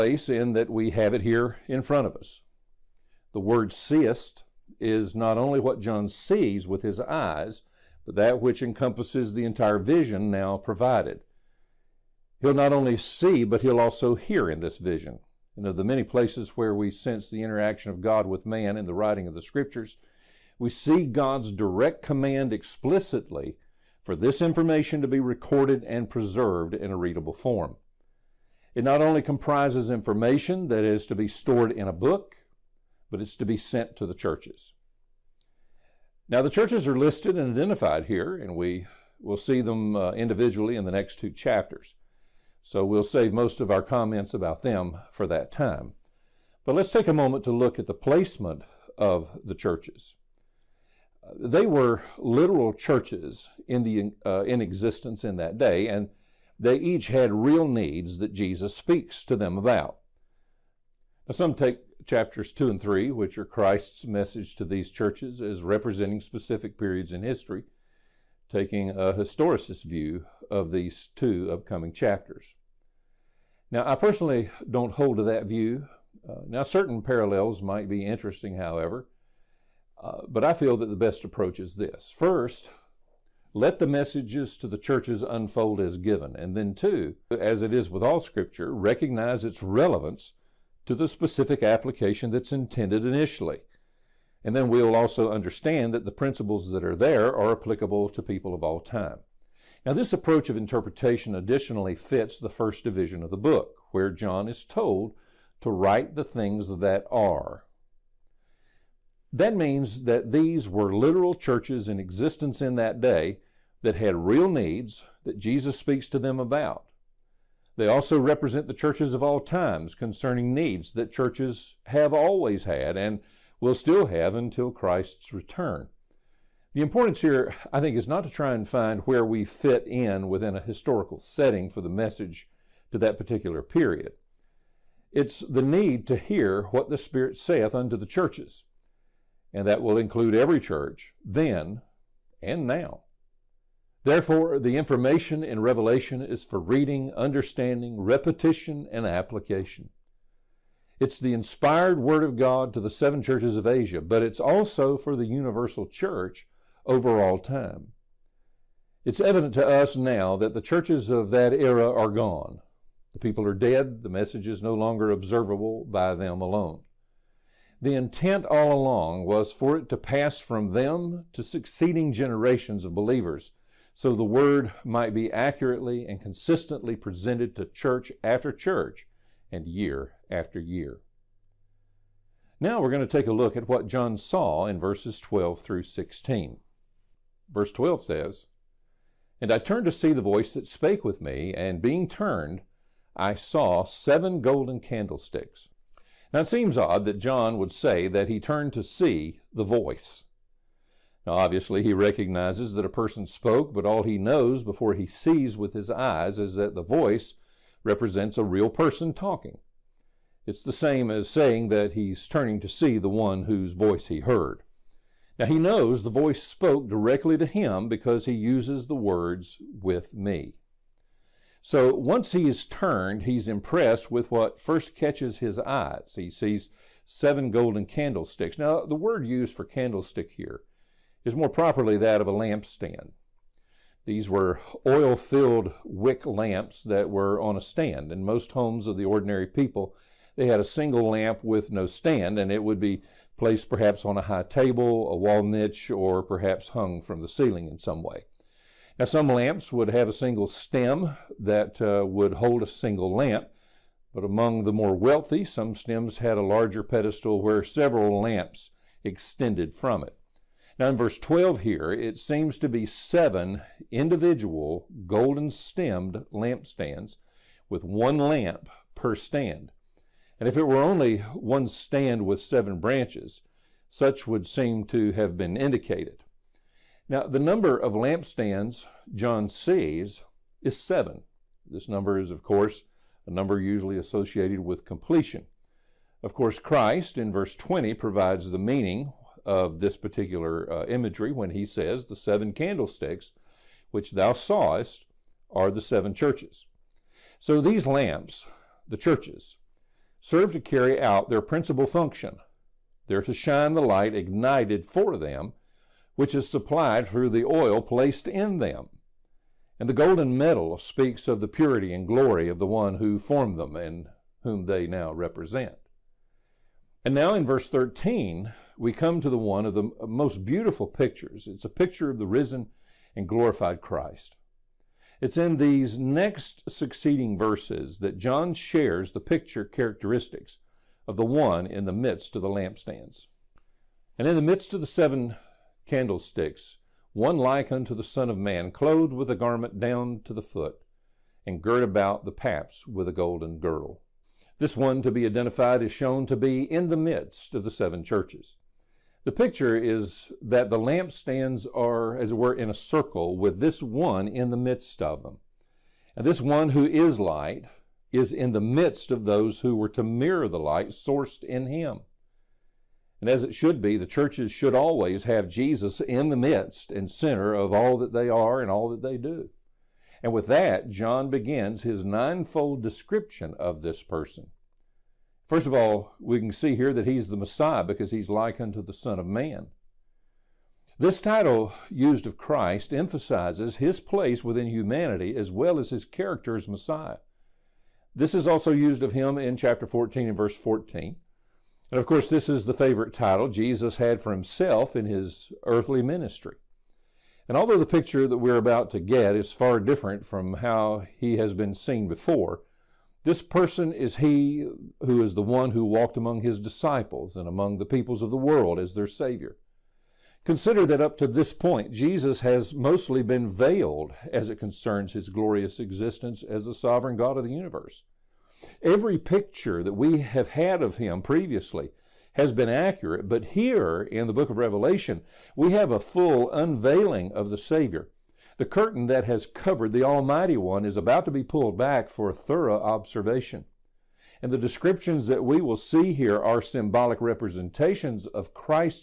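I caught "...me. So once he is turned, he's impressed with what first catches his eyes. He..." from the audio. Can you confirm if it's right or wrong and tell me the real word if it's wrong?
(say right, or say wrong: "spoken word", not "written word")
right.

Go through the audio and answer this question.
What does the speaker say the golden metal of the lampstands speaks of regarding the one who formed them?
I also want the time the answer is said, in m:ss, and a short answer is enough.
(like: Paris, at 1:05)
purity and glory, at 5:11.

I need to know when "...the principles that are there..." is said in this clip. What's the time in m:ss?
1:36.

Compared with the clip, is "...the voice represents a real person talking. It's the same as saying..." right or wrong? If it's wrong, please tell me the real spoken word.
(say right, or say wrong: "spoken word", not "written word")
right.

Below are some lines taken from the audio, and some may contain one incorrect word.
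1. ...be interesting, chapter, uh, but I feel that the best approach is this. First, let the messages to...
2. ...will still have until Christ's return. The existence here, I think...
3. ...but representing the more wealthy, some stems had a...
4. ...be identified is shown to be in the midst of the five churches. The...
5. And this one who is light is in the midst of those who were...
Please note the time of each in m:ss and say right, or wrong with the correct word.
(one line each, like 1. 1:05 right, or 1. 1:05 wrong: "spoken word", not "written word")
1. 1:17 wrong: "however", not "chapter"
2. 2:03 wrong: "importance", not "existence"
3. 4:14 wrong: "among", not "representing"
4. 5:45 wrong: "seven", not "five"
5. 5:56 right.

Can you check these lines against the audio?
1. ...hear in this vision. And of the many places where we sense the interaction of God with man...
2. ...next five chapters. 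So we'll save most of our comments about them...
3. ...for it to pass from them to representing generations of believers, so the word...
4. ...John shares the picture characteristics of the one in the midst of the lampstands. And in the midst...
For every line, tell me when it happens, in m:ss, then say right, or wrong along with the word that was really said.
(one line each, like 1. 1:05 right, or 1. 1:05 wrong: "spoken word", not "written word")
1. 0:14 right
2. 0:40 wrong: "two", not "five"
3. 2:49 wrong: "succeeding", not "representing"
4. 5:28 right.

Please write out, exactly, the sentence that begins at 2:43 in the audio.
The people are dead, the message is no longer observable by them alone.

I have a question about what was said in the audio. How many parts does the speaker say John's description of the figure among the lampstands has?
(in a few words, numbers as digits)
ninefold.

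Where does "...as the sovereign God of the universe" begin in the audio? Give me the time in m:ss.
6:56.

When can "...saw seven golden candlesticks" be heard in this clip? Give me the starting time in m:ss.
3:13.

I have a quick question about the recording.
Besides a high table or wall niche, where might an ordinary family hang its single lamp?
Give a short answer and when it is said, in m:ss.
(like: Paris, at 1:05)
from the ceiling, at 4:06.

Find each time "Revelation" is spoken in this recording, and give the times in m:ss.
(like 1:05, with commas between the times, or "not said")
2:25, 7:04.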